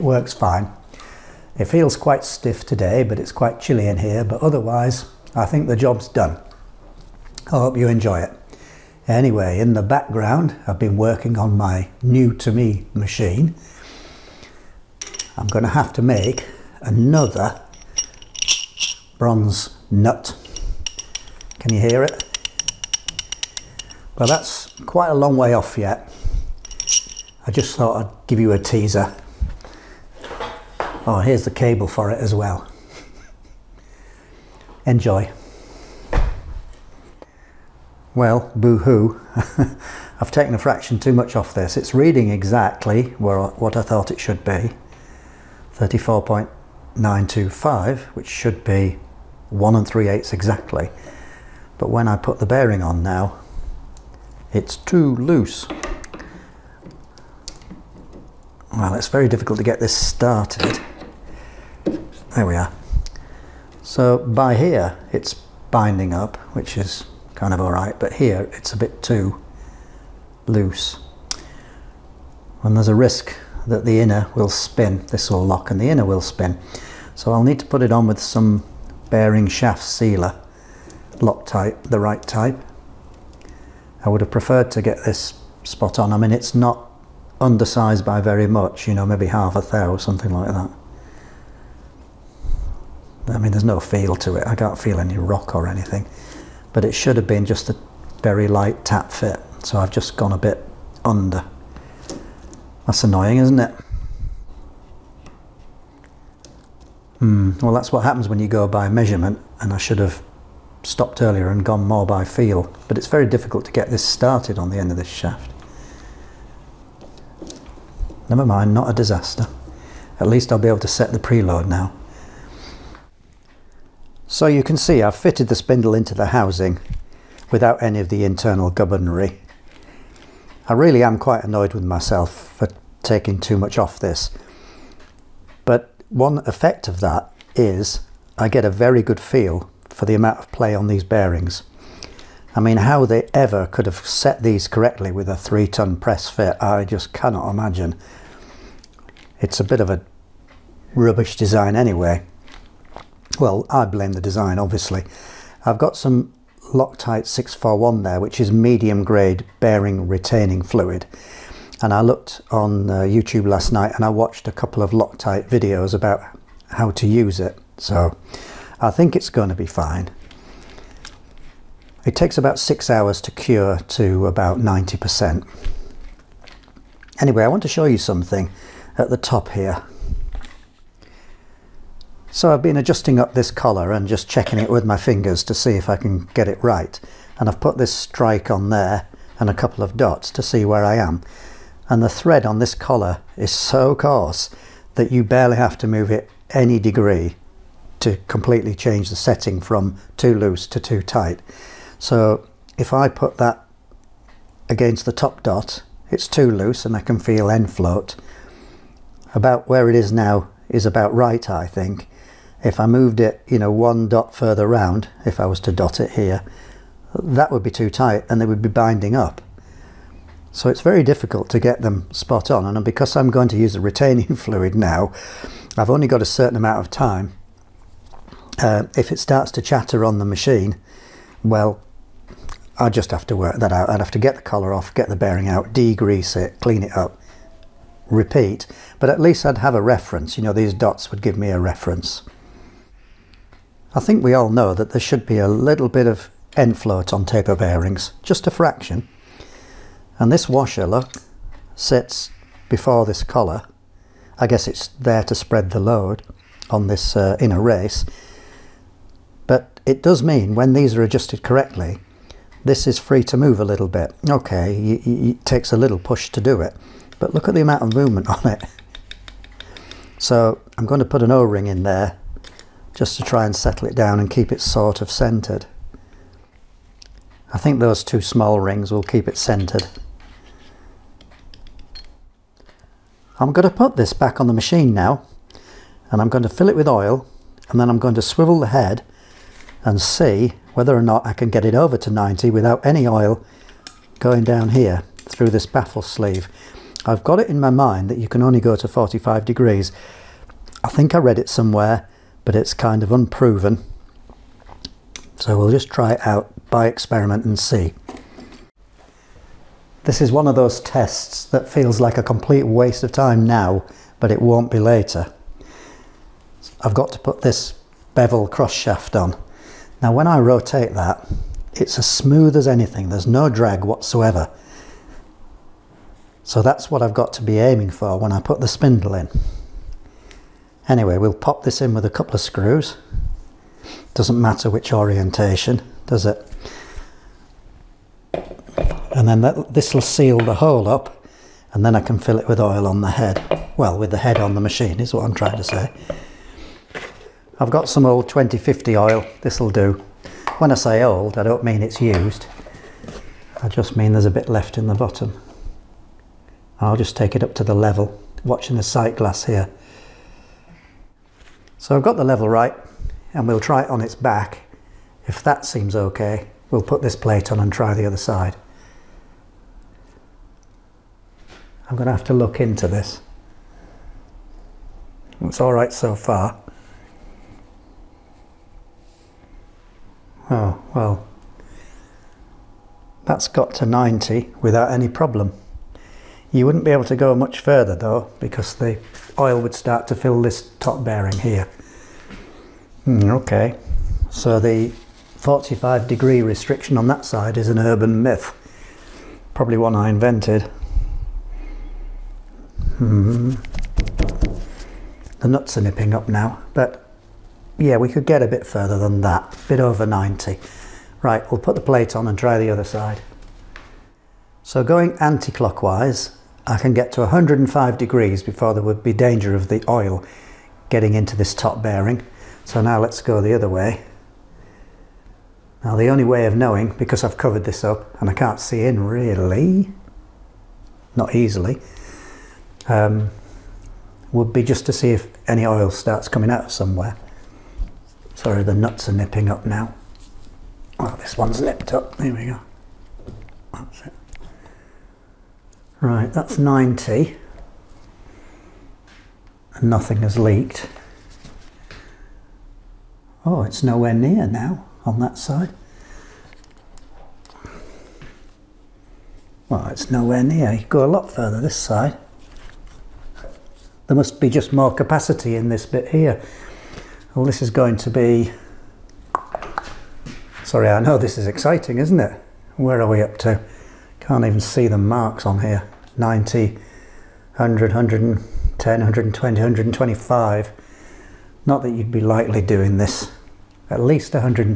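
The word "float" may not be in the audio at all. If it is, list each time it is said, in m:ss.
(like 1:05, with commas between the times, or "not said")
3:27, 4:06.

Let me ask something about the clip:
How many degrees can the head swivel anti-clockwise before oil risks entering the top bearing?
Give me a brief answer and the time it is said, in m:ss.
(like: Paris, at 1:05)
105, at 6:57.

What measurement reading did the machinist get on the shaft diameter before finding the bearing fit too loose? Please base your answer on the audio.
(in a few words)
34.925.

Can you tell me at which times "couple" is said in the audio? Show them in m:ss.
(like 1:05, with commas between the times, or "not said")
2:44, 3:09, 5:32.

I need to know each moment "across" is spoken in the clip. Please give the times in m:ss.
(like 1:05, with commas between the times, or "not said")
not said.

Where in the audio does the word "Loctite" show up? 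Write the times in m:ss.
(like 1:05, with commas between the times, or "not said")
1:21, 2:36, 2:44.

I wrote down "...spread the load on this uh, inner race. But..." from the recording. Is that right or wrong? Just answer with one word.
right.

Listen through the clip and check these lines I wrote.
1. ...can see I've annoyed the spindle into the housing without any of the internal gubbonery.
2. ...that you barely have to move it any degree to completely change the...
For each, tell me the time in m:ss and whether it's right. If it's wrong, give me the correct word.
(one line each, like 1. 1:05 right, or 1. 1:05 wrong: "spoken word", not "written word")
1. 2:04 wrong: "fitted", not "annoyed"
2. 3:14 right.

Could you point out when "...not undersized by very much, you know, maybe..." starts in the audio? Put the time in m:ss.
1:26.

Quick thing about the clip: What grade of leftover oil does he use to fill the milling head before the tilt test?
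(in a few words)
2050.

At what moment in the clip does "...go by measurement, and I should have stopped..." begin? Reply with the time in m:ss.
1:48.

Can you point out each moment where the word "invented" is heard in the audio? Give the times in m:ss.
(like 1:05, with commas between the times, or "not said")
6:40.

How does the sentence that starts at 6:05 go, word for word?
If that seems okay, we'll put this plate on and try the other side.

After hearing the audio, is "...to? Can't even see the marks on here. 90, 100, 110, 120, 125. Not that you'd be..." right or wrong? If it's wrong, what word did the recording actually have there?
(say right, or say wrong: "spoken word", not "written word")
right.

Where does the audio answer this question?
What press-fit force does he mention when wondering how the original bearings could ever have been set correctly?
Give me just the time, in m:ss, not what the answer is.
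2:25.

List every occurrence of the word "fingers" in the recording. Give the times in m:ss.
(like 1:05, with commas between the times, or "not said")
3:04.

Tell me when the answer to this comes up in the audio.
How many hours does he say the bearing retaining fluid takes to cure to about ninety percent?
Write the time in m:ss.
2:52.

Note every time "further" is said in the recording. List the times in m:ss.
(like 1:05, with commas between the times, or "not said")
3:34, 6:27, 6:48, 7:41.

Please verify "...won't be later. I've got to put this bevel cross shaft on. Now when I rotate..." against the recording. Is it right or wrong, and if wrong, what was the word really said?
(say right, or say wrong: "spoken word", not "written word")
right.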